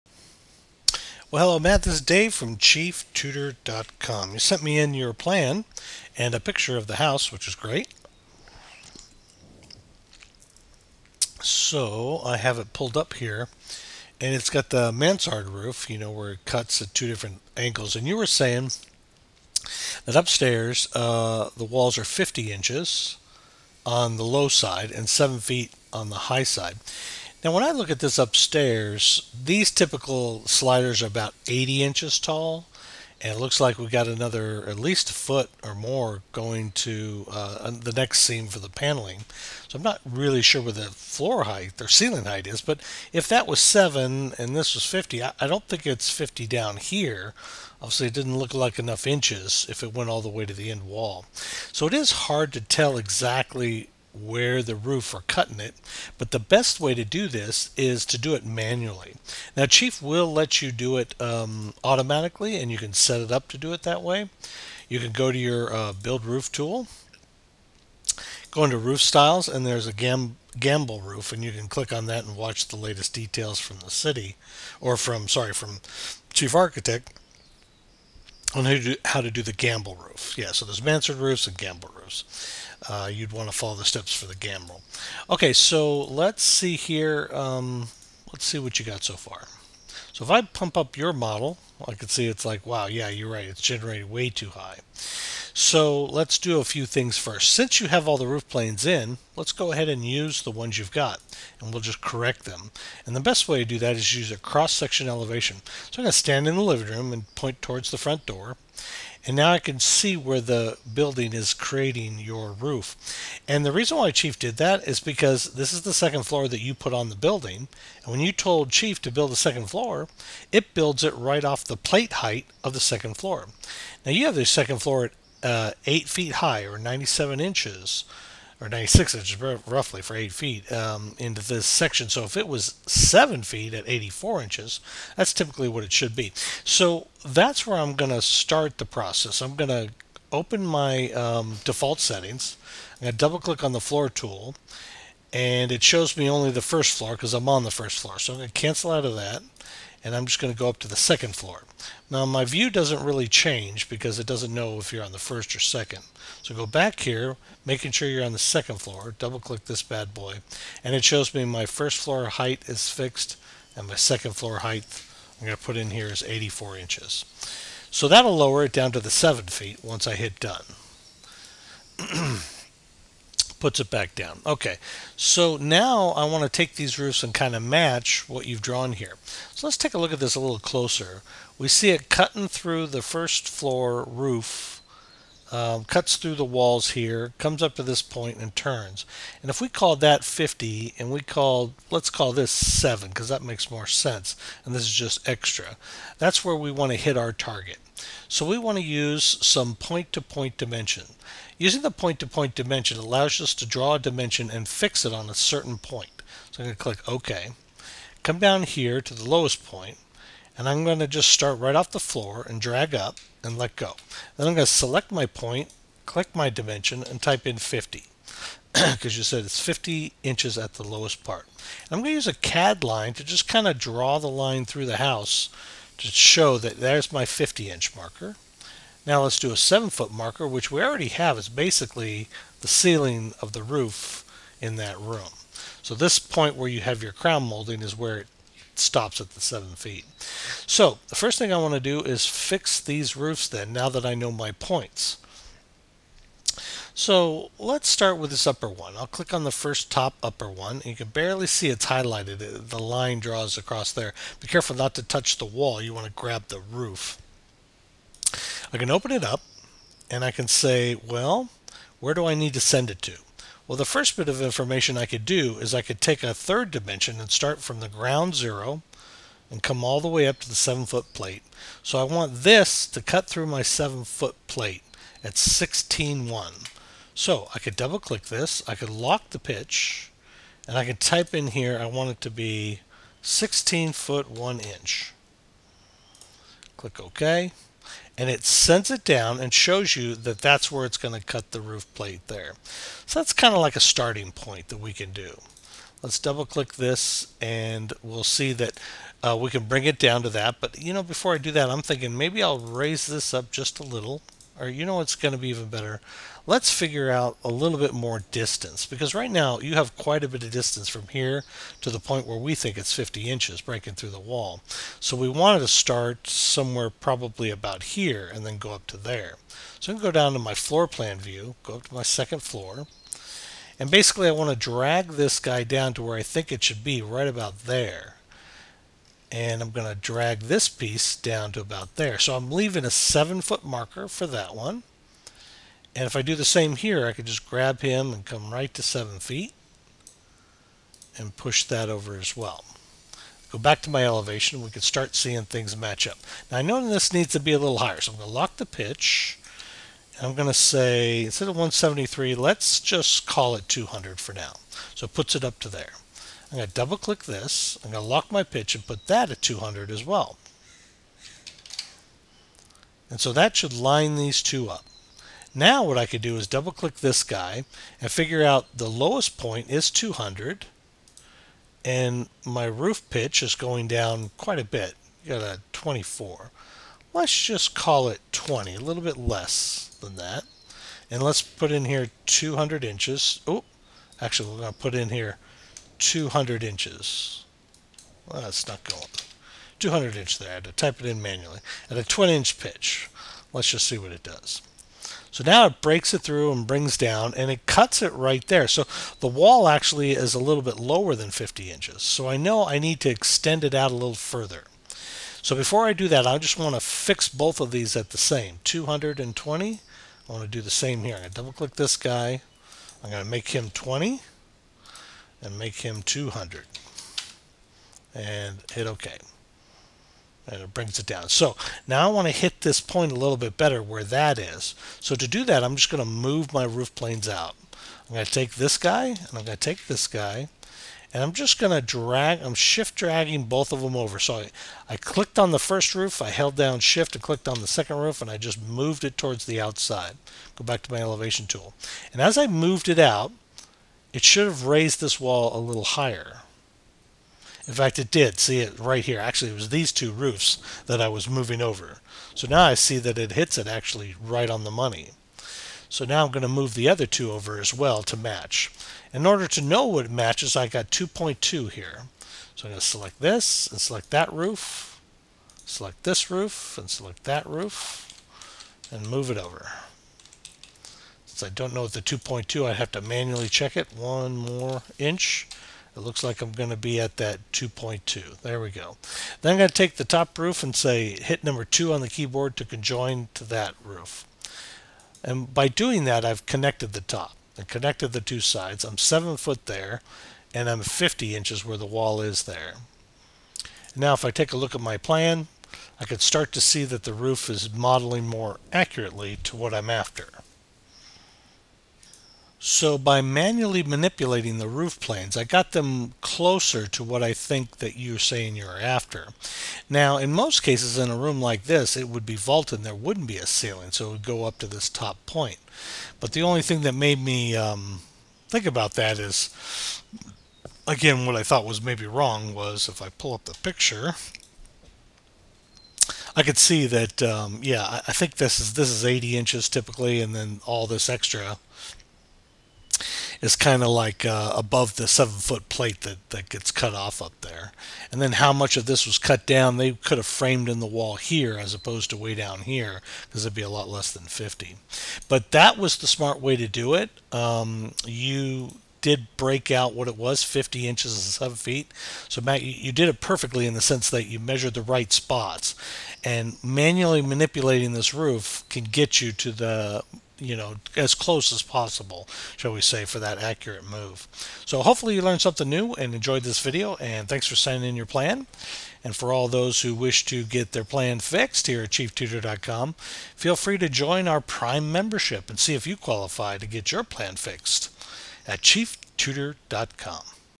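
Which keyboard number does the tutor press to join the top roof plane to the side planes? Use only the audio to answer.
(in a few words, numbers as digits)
2.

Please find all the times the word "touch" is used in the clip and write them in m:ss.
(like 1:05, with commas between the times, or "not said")
4:15.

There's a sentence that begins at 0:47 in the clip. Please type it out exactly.
Obviously, it didn't look like enough inches if it went all the way to the end wall.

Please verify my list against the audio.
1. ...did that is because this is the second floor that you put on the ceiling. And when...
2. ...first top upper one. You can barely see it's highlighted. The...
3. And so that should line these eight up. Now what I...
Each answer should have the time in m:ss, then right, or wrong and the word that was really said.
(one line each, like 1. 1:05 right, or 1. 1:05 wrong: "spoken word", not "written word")
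1. 1:54 wrong: "building", not "ceiling"
2. 4:09 right
3. 6:03 wrong: "two", not "eight".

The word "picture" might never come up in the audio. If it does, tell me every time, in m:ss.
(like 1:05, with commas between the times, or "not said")
0:06, 8:43.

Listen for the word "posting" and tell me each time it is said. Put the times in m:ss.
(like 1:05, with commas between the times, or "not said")
not said.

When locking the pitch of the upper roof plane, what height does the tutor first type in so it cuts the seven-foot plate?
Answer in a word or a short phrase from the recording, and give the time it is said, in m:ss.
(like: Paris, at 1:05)
16 foot 1 inch, at 4:43.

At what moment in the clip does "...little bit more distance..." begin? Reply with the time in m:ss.
5:07.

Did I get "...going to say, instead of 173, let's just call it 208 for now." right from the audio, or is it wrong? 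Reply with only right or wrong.
wrong.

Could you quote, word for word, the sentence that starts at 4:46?
Click OK and it sends it down and shows you that that's where it's going to cut the roof plate there.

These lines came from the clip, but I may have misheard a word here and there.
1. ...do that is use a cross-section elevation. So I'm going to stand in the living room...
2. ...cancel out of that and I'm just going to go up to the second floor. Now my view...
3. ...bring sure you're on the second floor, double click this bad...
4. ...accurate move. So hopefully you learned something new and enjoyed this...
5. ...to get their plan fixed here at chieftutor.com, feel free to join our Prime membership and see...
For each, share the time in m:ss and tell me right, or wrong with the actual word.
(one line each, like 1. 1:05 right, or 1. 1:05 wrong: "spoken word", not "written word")
1. 1:43 right
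2. 2:28 right
3. 2:37 wrong: "making", not "bring"
4. 9:23 right
5. 9:30 right.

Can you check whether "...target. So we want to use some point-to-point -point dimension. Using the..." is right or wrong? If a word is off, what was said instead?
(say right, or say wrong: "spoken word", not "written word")
right.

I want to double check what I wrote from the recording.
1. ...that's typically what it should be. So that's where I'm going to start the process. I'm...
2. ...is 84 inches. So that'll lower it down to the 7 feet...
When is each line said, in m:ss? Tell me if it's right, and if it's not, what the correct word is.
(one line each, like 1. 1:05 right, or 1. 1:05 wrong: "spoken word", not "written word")
1. 2:15 right
2. 2:46 right.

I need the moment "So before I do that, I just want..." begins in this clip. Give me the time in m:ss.
6:45.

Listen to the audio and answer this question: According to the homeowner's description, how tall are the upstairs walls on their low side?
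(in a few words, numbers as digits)
50 inches.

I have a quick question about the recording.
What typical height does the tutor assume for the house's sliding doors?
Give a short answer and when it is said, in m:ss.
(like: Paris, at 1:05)
80 inches, at 0:31.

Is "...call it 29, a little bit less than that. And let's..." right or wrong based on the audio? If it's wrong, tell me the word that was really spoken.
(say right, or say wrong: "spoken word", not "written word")
wrong: "20", not "29".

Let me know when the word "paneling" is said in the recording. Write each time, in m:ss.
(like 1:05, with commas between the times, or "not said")
0:38.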